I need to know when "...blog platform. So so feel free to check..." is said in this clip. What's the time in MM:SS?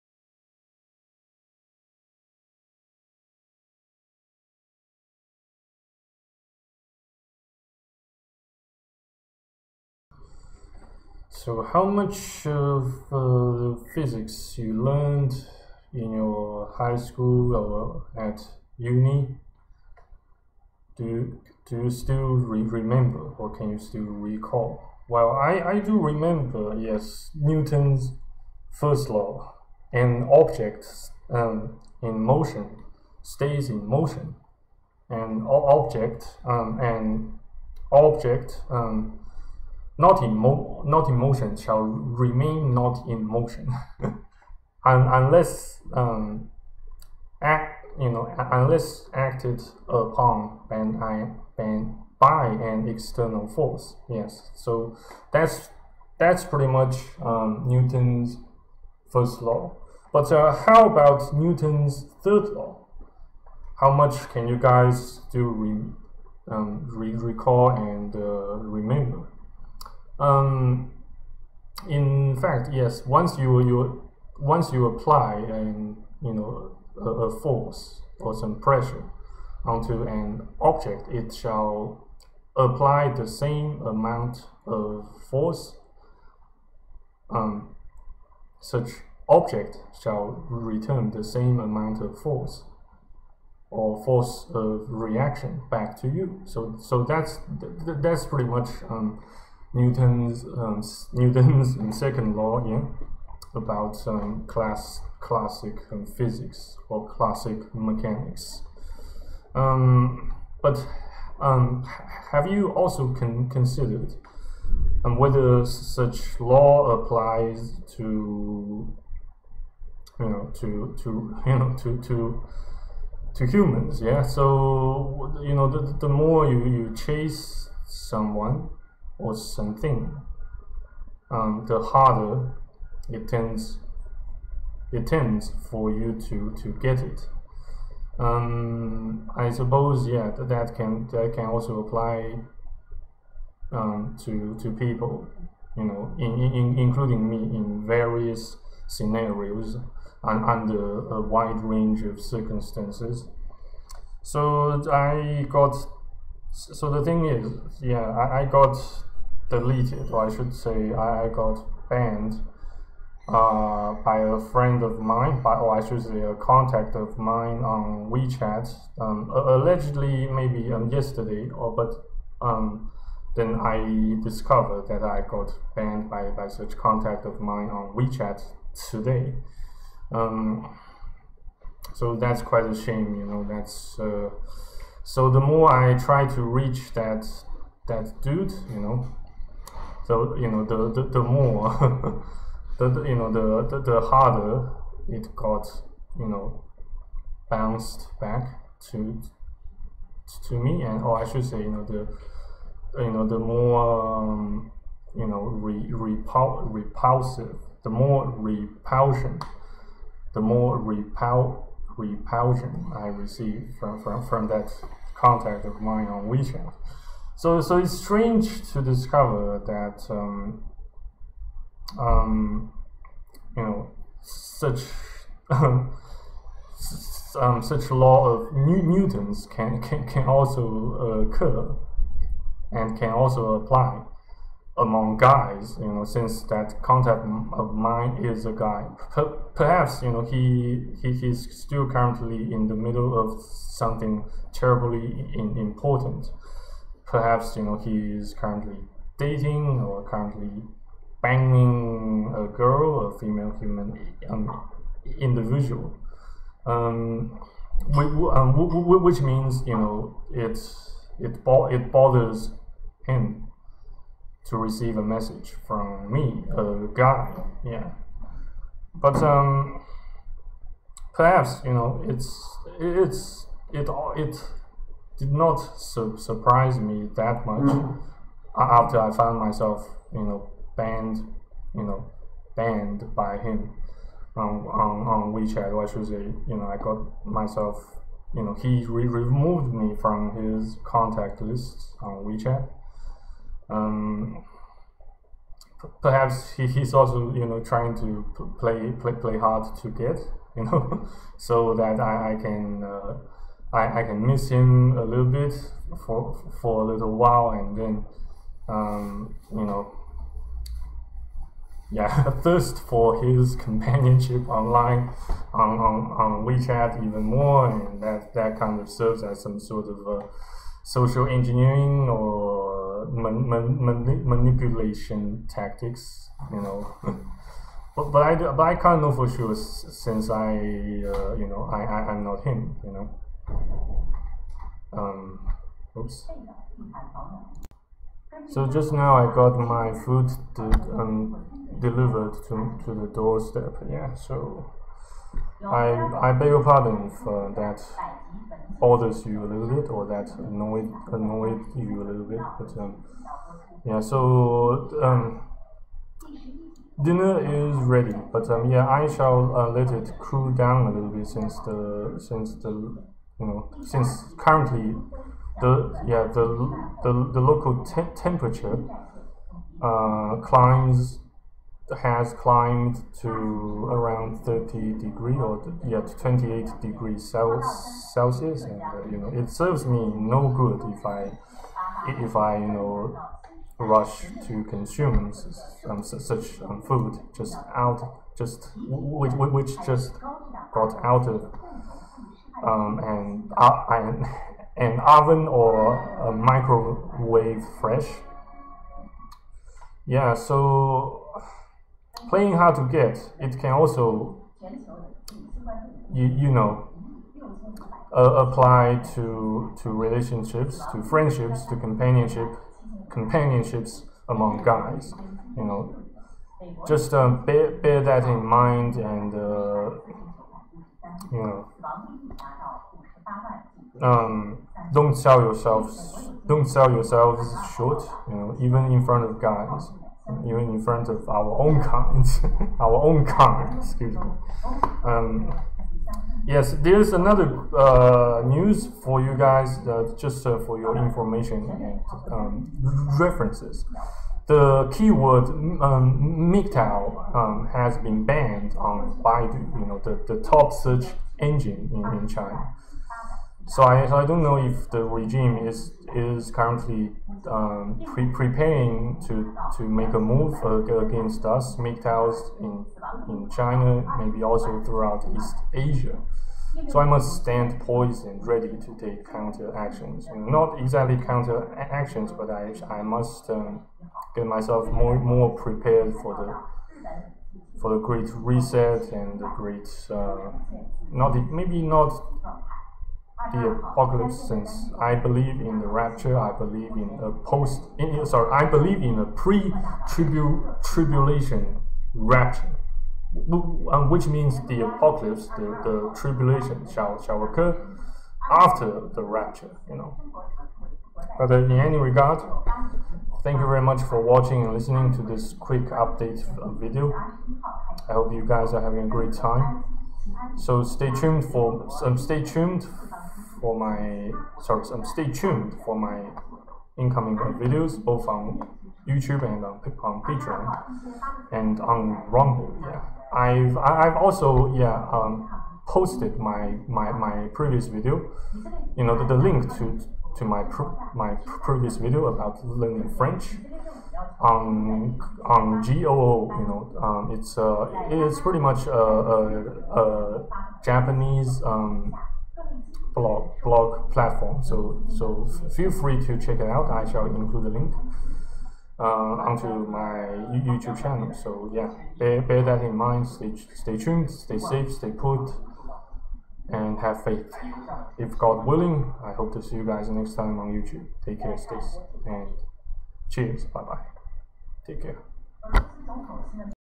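09:03.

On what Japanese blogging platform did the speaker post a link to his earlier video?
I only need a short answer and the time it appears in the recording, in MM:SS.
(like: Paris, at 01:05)
GOO, at 08:55.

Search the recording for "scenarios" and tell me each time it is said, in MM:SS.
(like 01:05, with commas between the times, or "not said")
02:28.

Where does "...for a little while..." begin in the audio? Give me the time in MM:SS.
05:06.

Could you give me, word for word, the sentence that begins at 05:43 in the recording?
Yeah, so I, I beg your pardon for that bothers you a little bit or that annoyed, annoyed you a little bit.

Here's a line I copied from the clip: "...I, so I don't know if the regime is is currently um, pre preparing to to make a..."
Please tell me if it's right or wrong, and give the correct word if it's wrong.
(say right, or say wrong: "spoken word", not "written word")
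right.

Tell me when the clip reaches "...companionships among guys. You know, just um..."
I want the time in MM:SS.
06:53.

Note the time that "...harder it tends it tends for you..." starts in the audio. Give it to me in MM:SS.
02:11.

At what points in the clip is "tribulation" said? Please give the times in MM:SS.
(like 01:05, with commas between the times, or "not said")
08:10, 08:16.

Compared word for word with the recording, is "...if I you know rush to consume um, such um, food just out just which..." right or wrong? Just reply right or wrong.
right.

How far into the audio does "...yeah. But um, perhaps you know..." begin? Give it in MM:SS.
04:27.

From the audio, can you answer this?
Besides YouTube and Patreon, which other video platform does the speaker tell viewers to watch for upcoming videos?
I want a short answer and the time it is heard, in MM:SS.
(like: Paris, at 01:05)
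Rumble, at 08:42.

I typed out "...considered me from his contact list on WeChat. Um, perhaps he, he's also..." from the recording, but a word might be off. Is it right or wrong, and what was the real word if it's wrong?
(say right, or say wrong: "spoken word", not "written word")
wrong: "removed", not "considered".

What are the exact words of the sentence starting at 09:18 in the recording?
If God willing, I hope to see you guys next time on YouTube.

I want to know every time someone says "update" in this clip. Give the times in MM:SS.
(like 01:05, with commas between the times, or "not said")
08:25.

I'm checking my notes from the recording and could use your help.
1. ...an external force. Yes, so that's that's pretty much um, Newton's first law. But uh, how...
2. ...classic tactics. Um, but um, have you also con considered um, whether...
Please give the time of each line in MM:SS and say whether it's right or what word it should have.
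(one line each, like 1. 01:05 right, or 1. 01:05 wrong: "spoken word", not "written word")
1. 00:52 right
2. 01:47 wrong: "mechanics", not "tactics".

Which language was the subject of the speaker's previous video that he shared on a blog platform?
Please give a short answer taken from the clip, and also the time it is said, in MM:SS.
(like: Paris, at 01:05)
French, at 08:53.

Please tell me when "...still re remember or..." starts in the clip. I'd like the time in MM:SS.
00:21.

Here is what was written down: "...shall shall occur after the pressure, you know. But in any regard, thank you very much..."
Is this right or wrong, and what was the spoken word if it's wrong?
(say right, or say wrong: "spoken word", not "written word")
wrong: "rapture", not "pressure".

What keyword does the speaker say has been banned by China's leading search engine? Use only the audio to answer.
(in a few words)
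MGTOW.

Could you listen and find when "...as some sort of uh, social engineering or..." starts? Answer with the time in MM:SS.
05:19.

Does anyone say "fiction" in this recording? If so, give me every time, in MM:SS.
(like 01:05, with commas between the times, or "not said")
not said.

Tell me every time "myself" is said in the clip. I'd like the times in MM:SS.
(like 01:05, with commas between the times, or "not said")
04:39, 04:47, 07:54.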